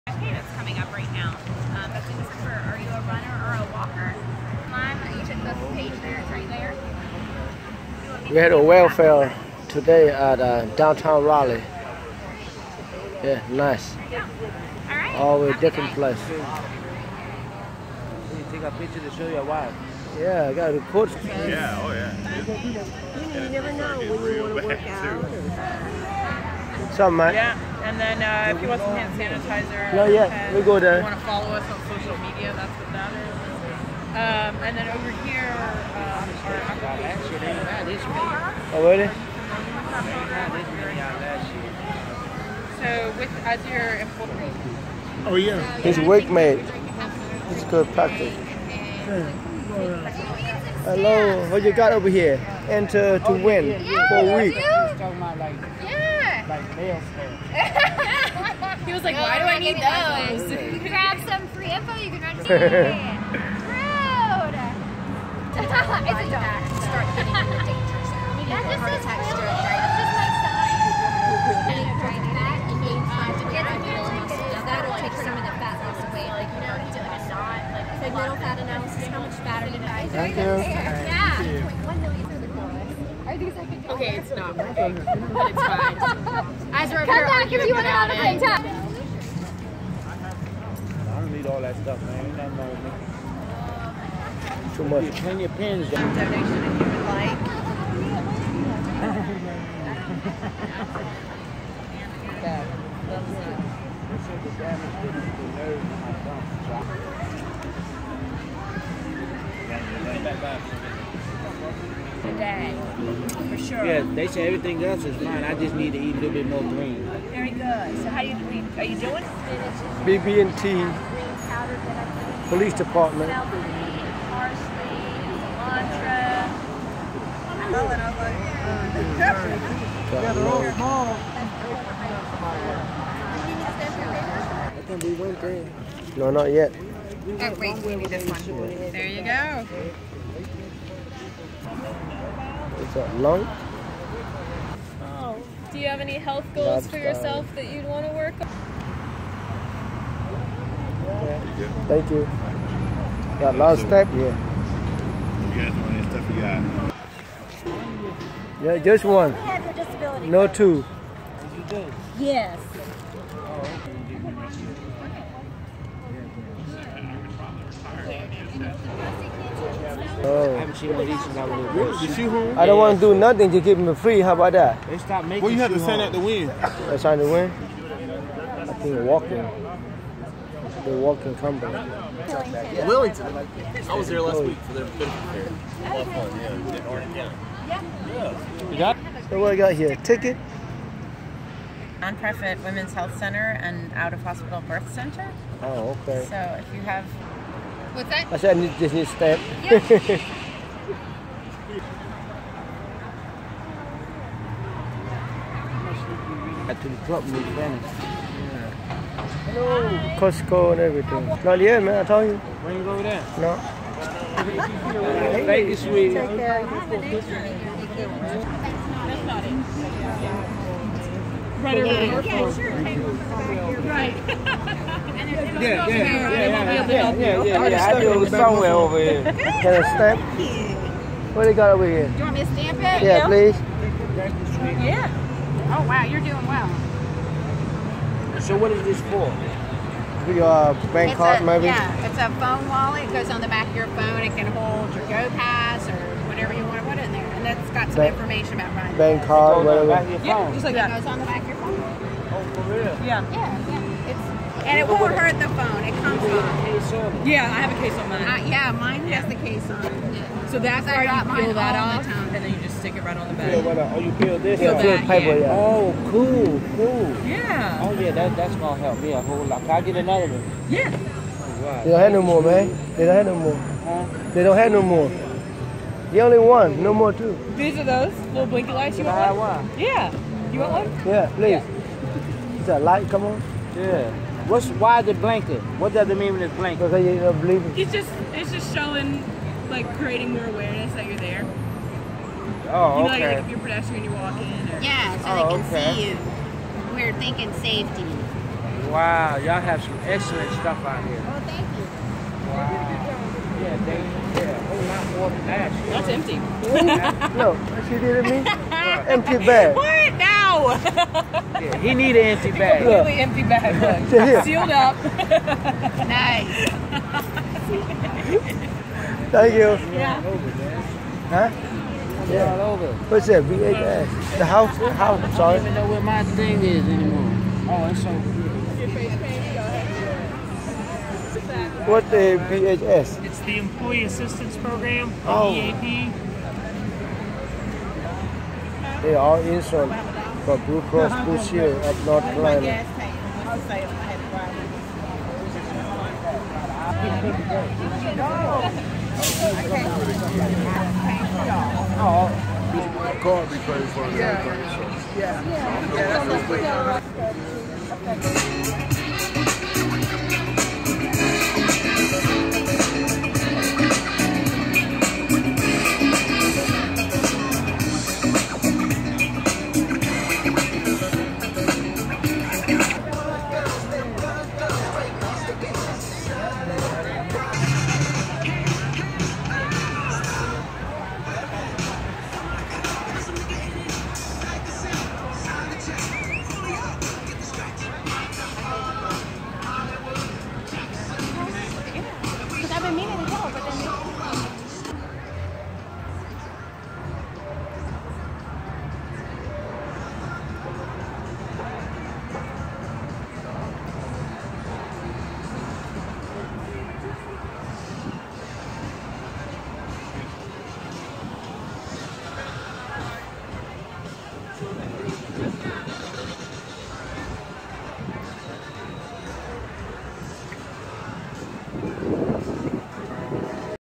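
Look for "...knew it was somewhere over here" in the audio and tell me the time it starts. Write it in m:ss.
3:47.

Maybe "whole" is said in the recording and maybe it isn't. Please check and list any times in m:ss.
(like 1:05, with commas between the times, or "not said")
4:29, 5:04.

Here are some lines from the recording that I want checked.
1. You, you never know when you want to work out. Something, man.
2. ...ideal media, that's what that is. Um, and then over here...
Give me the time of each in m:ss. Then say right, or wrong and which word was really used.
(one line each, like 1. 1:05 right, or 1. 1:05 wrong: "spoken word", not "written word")
1. 0:23 right
2. 0:31 wrong: "social", not "ideal".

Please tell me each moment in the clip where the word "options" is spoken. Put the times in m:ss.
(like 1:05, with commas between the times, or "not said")
not said.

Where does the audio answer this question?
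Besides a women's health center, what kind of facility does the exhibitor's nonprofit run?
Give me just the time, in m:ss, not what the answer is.
3:13.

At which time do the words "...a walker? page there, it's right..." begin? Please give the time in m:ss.
0:03.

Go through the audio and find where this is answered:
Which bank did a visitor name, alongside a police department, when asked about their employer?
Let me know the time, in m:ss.
2:00.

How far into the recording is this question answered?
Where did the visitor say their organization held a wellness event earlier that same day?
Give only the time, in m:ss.
0:10.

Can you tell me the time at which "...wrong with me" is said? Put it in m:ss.
1:32.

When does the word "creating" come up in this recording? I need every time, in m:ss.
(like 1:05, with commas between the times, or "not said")
4:49.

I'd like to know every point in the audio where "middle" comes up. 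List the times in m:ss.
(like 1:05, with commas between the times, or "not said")
1:18.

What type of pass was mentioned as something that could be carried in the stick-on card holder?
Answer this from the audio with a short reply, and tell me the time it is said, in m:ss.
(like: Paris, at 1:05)
Go Pass, at 4:05.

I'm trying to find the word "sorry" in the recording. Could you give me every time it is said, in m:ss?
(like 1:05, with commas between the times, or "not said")
5:25.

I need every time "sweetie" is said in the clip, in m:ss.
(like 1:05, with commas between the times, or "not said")
3:35.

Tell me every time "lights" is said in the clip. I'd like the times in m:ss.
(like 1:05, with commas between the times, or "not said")
4:38, 4:42.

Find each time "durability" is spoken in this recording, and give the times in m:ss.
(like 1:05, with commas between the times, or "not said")
not said.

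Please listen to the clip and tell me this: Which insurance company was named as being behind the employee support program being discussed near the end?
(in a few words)
Blue Cross Blue Shield of North Carolina.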